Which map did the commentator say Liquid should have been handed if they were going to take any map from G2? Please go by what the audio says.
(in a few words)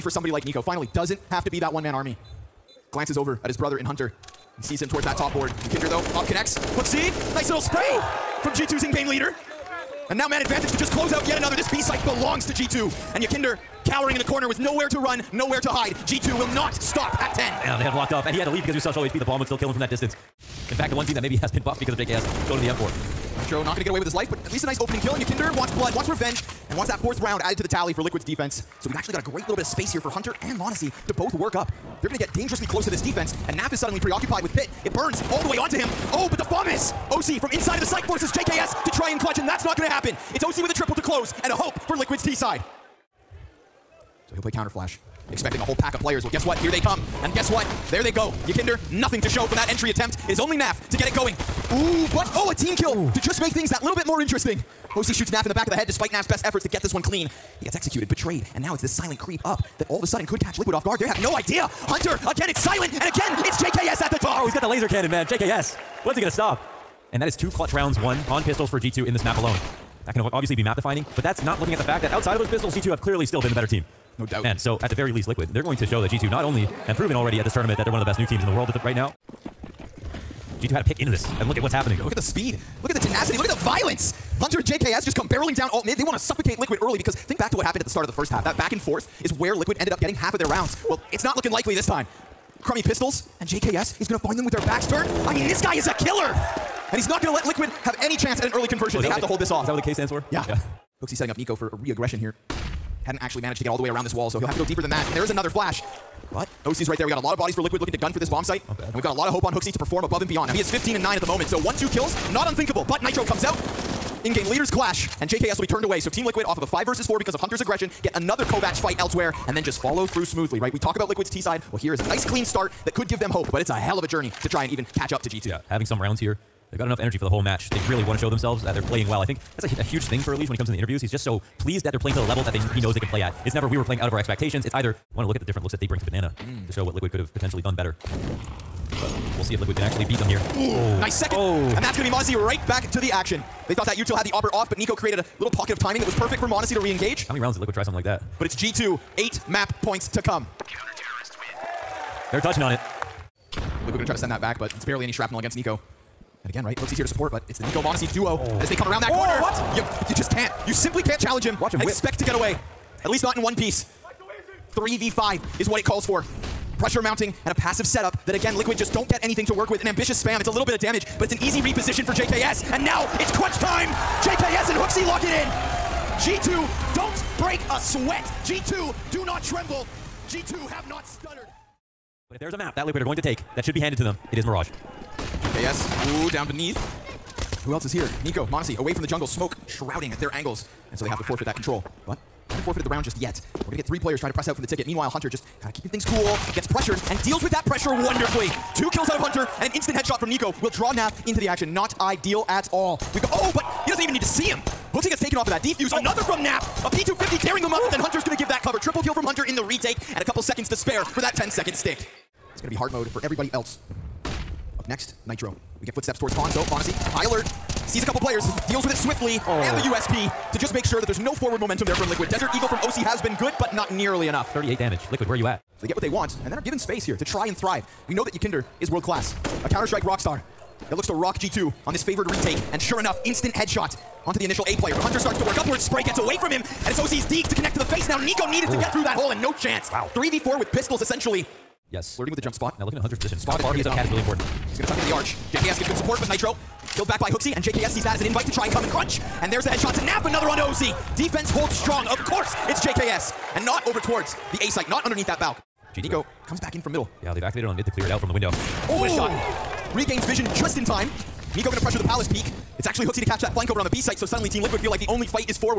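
Mirage.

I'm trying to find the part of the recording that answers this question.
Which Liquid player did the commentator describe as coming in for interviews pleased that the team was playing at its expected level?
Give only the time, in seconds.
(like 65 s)
130 s.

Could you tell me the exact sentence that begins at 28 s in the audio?
So we've actually got a great little bit of space here for Hunter and Monesy to both work up.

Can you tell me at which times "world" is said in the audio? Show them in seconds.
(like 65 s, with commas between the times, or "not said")
78 s, 228 s.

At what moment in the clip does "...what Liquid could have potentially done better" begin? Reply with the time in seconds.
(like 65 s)
136 s.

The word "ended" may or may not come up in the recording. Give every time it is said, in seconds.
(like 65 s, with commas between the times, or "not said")
89 s.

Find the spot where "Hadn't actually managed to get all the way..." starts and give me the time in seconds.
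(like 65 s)
103 s.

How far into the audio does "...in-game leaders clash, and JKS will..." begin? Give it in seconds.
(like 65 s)
114 s.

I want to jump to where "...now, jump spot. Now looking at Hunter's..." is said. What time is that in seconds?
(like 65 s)
242 s.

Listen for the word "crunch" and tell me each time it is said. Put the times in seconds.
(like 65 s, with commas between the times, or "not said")
173 s, 248 s.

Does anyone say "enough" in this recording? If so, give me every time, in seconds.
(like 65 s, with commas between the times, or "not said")
126 s, 224 s, 232 s.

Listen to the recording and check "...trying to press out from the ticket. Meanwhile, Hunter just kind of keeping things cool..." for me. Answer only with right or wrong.
right.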